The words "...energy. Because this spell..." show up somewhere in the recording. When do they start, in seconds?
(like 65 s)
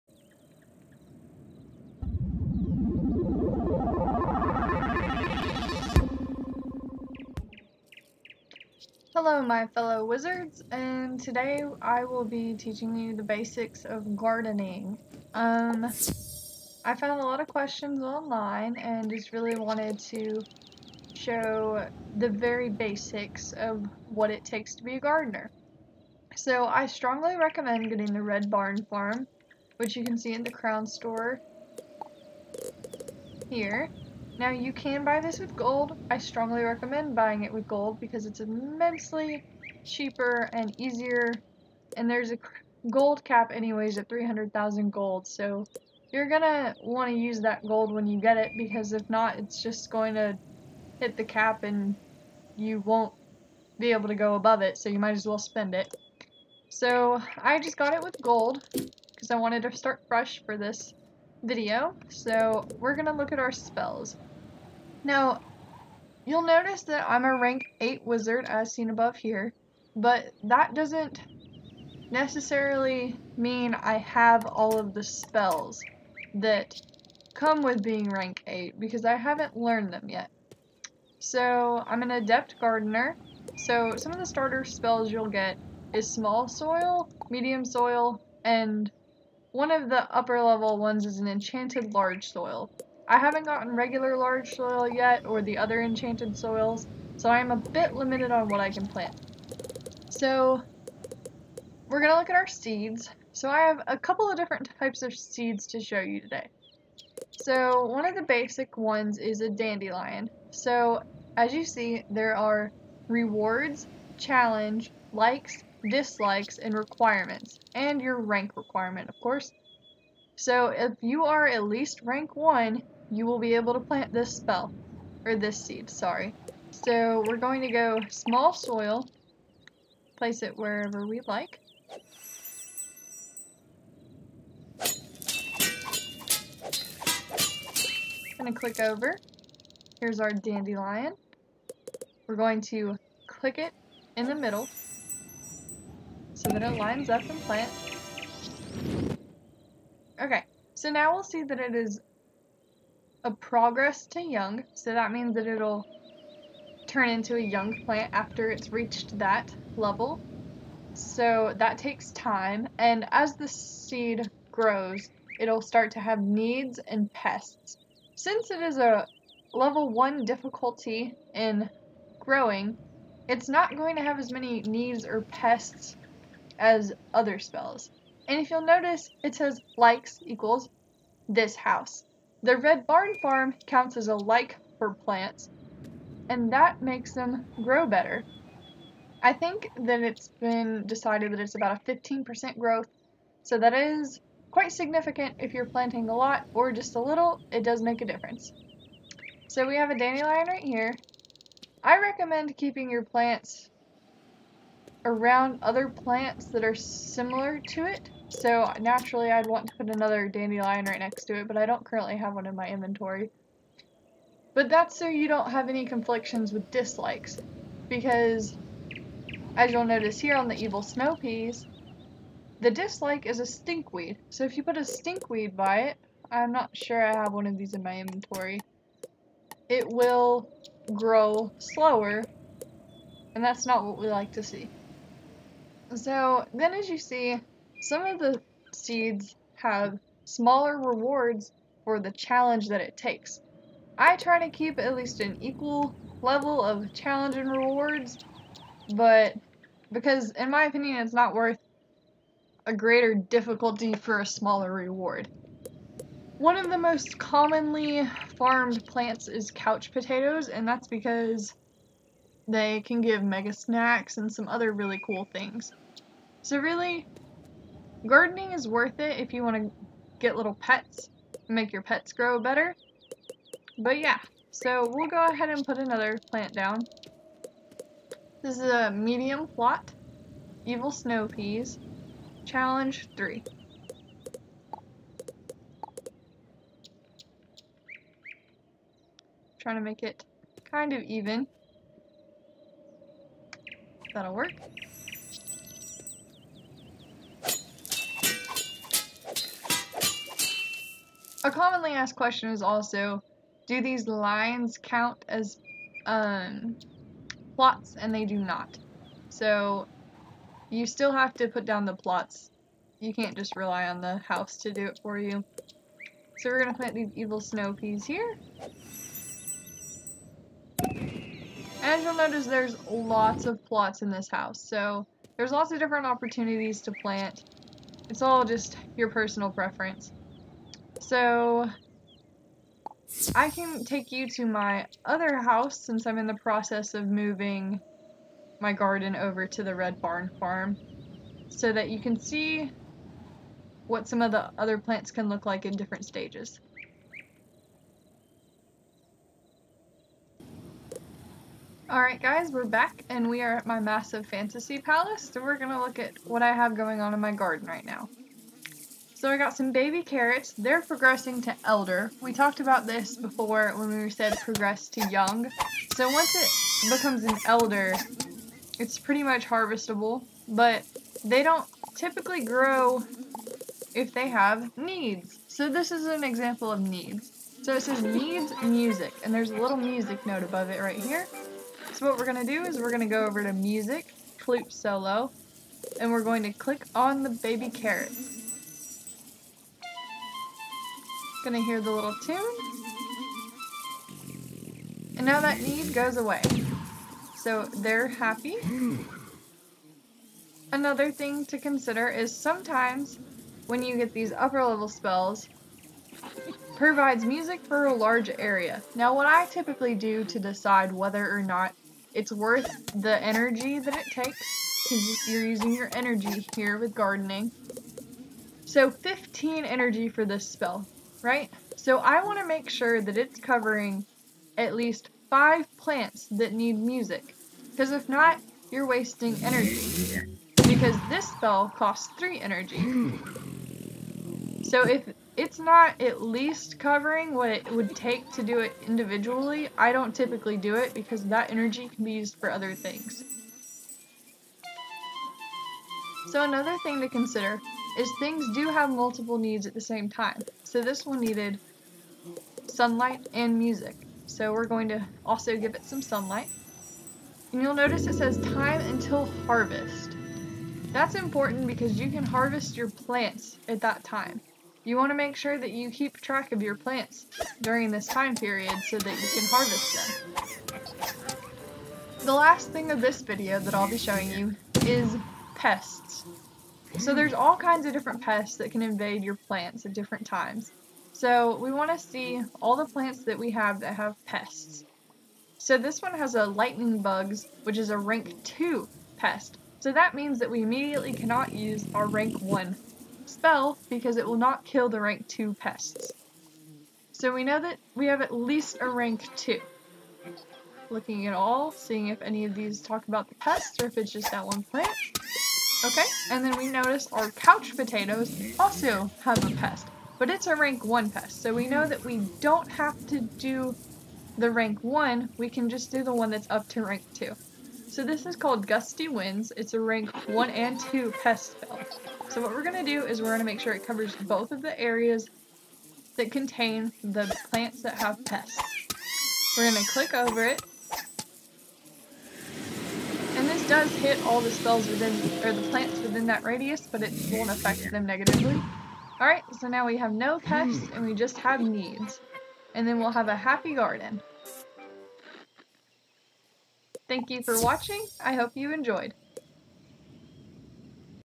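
429 s.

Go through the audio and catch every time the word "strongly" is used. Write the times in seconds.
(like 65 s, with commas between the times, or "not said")
26 s, 36 s.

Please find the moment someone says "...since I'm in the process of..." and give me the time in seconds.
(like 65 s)
335 s.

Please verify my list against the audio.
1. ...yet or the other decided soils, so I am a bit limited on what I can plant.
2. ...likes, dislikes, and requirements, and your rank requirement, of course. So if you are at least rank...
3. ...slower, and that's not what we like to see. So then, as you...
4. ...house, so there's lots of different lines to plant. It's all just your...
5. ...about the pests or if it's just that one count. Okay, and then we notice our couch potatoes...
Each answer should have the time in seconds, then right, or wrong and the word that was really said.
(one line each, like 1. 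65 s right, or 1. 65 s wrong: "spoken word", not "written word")
1. 94 s wrong: "enchanted", not "decided"
2. 115 s right
3. 231 s right
4. 324 s wrong: "opportunities", not "lines"
5. 503 s wrong: "plant", not "count".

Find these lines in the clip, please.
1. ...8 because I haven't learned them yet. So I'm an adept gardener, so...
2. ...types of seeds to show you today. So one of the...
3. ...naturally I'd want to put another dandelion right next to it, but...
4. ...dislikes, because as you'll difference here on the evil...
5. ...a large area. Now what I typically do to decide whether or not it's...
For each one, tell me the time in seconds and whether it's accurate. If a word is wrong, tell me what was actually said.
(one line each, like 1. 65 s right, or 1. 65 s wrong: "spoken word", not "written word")
1. 78 s right
2. 104 s right
3. 208 s right
4. 216 s wrong: "notice", not "difference"
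5. 407 s right.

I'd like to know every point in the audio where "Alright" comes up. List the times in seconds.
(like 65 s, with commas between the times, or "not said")
351 s, 539 s.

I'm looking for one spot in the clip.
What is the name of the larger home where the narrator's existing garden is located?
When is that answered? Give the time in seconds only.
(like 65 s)
354 s.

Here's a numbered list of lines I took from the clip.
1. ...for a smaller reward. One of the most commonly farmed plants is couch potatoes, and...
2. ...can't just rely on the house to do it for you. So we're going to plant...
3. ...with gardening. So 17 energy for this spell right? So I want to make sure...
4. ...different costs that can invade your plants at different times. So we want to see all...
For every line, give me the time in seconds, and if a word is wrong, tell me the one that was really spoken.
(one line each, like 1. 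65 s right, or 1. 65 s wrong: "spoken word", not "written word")
1. 253 s right
2. 313 s right
3. 416 s wrong: "15", not "17"
4. 477 s wrong: "pests", not "costs".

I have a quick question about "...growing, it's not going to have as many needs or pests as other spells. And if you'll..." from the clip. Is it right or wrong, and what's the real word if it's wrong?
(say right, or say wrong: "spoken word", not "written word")
right.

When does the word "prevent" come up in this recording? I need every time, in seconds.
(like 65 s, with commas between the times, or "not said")
not said.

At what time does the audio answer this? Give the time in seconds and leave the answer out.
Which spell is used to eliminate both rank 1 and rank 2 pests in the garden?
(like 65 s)
518 s.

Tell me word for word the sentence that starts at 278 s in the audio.
This is a medium plot, evil snow peas, challenge 3.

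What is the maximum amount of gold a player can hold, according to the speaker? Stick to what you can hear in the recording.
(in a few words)
300,000.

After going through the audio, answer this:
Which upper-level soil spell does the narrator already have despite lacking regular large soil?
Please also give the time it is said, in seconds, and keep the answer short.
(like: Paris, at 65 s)
enchanted large soil, at 91 s.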